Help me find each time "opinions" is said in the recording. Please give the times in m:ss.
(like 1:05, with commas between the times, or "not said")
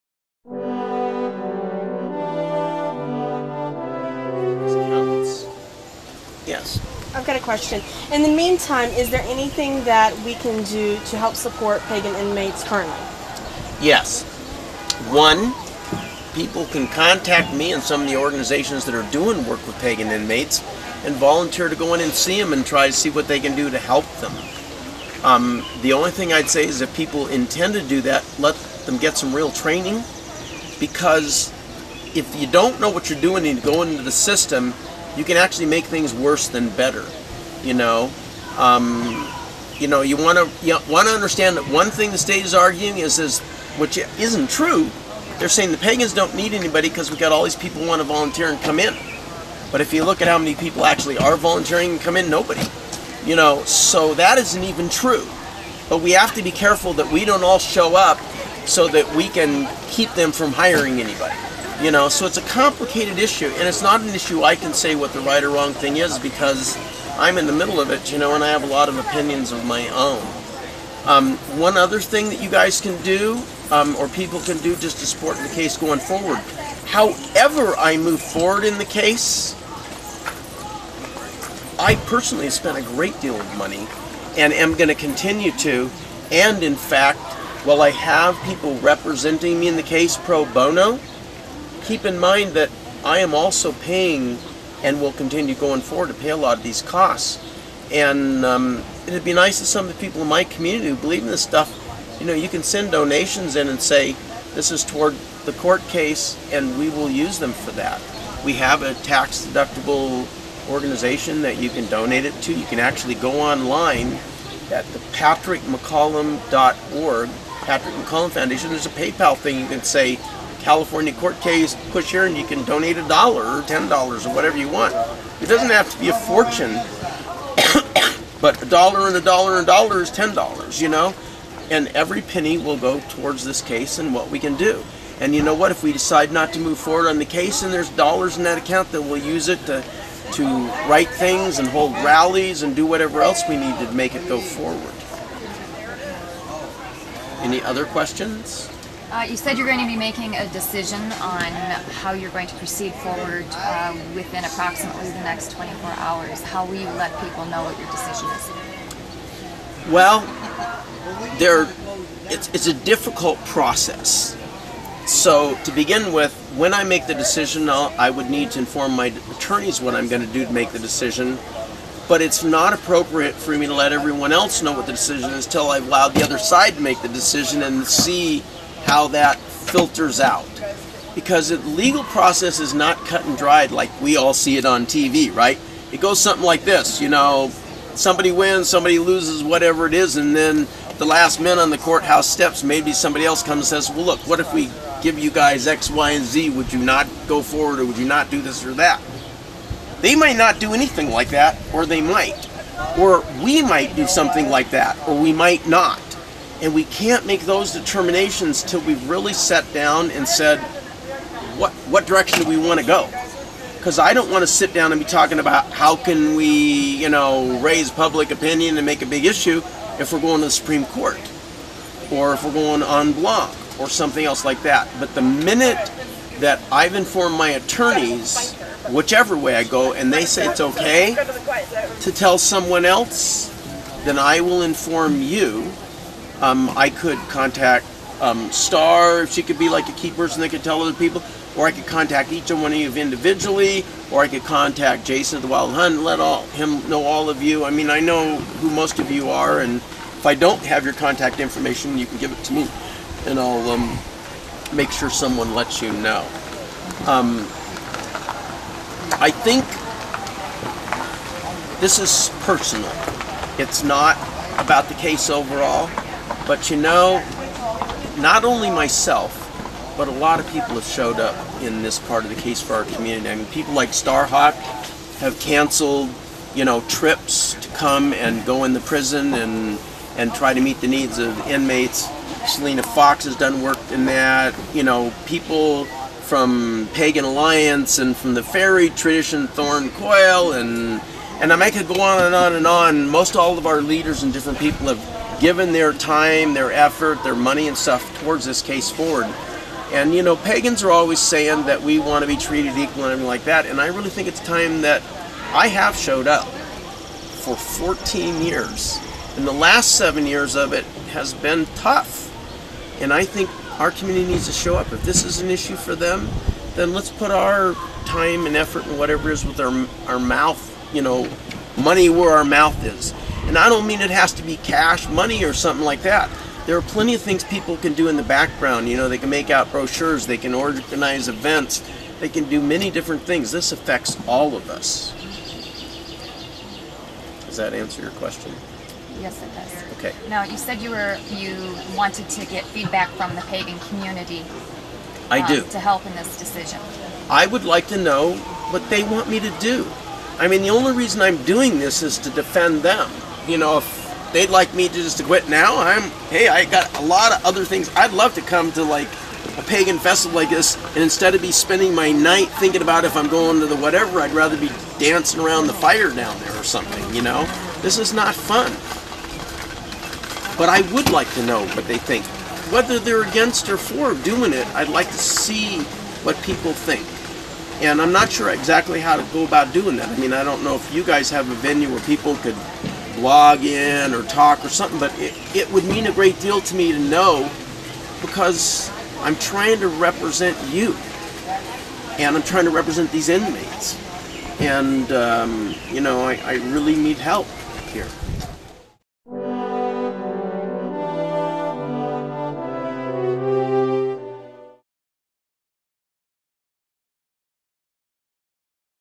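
1:08, 3:38.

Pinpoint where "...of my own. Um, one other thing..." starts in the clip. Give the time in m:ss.
1:09.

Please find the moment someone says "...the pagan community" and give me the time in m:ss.
5:43.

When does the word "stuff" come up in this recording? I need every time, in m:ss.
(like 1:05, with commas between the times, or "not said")
1:41, 4:57.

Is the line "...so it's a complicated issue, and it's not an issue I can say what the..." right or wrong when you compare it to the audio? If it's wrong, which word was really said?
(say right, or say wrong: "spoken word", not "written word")
right.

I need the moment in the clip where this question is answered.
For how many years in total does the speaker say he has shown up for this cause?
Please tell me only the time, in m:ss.
5:07.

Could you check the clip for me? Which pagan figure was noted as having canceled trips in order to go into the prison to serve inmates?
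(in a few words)
Starhawk.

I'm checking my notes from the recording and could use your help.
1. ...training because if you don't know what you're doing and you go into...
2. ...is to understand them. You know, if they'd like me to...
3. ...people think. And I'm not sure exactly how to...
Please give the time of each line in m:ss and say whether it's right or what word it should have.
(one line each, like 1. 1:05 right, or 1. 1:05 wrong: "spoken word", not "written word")
1. 0:29 right
2. 5:52 wrong: "defend", not "understand"
3. 6:16 right.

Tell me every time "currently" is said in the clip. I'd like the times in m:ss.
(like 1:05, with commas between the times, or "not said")
0:12.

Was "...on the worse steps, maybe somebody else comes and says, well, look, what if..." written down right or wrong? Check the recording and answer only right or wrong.
wrong.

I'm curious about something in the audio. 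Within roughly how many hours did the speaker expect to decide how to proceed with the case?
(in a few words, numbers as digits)
24.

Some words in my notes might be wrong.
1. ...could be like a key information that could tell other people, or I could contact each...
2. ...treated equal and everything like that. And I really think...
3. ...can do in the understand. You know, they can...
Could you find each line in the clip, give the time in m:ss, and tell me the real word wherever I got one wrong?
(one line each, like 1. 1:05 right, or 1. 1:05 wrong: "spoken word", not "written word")
1. 3:59 wrong: "person", not "information"
2. 5:02 right
3. 5:27 wrong: "background", not "understand".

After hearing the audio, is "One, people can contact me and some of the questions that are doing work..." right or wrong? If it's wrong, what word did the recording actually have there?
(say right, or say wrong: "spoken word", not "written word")
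wrong: "organizations", not "questions".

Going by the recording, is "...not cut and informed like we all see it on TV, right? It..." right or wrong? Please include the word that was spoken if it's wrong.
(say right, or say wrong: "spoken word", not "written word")
wrong: "dried", not "informed".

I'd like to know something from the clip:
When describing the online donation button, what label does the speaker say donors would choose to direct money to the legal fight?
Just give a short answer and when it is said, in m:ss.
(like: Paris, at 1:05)
California court case, at 2:00.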